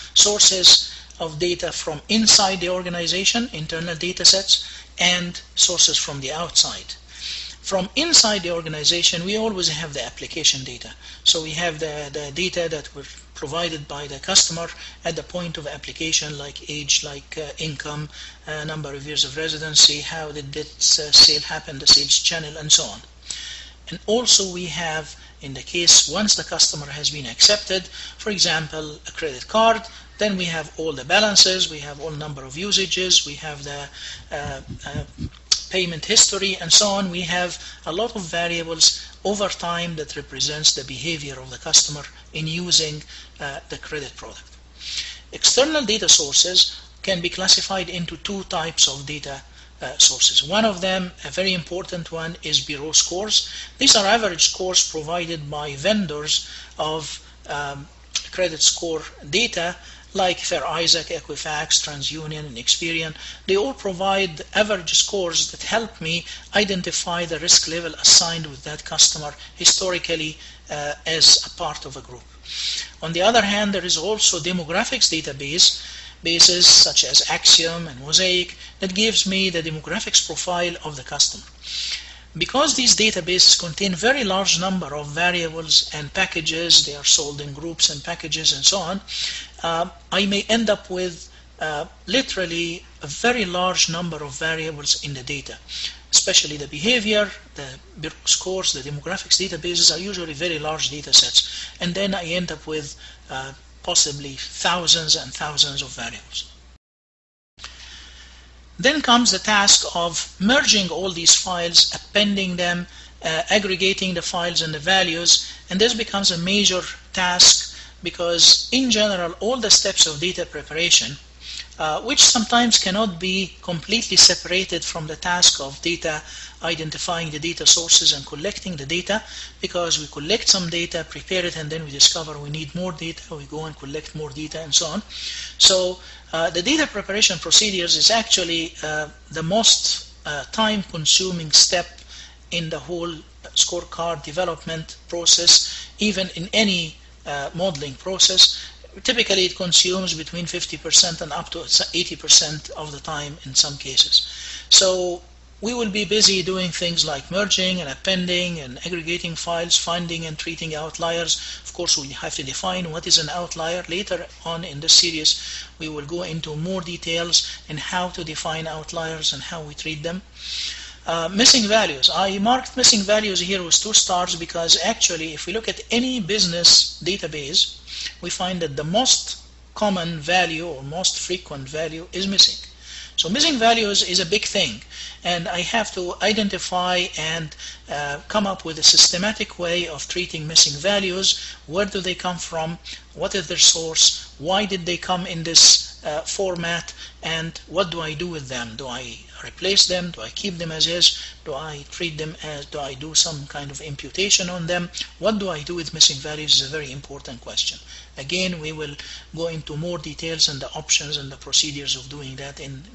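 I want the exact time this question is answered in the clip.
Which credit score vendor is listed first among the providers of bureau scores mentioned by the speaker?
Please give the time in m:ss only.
1:00.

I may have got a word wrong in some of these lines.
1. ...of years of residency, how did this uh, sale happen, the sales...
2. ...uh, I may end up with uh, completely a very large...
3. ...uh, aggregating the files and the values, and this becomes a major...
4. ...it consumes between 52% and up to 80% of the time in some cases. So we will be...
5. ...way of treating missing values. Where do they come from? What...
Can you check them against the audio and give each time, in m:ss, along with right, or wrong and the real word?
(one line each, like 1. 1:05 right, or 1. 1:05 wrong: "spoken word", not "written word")
1. 0:18 right
2. 1:29 wrong: "literally", not "completely"
3. 1:53 right
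4. 2:29 wrong: "50", not "52"
5. 3:09 right.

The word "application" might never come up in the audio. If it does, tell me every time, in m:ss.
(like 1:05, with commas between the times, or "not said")
0:10, 0:15.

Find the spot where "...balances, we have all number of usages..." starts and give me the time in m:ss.
0:31.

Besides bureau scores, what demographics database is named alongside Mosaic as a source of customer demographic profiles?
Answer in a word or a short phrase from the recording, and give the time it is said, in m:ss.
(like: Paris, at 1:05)
Acxiom, at 1:17.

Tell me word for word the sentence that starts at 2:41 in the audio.
Of course, we have to define what is an outlier.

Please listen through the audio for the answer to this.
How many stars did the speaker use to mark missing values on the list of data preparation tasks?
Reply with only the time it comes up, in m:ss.
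2:53.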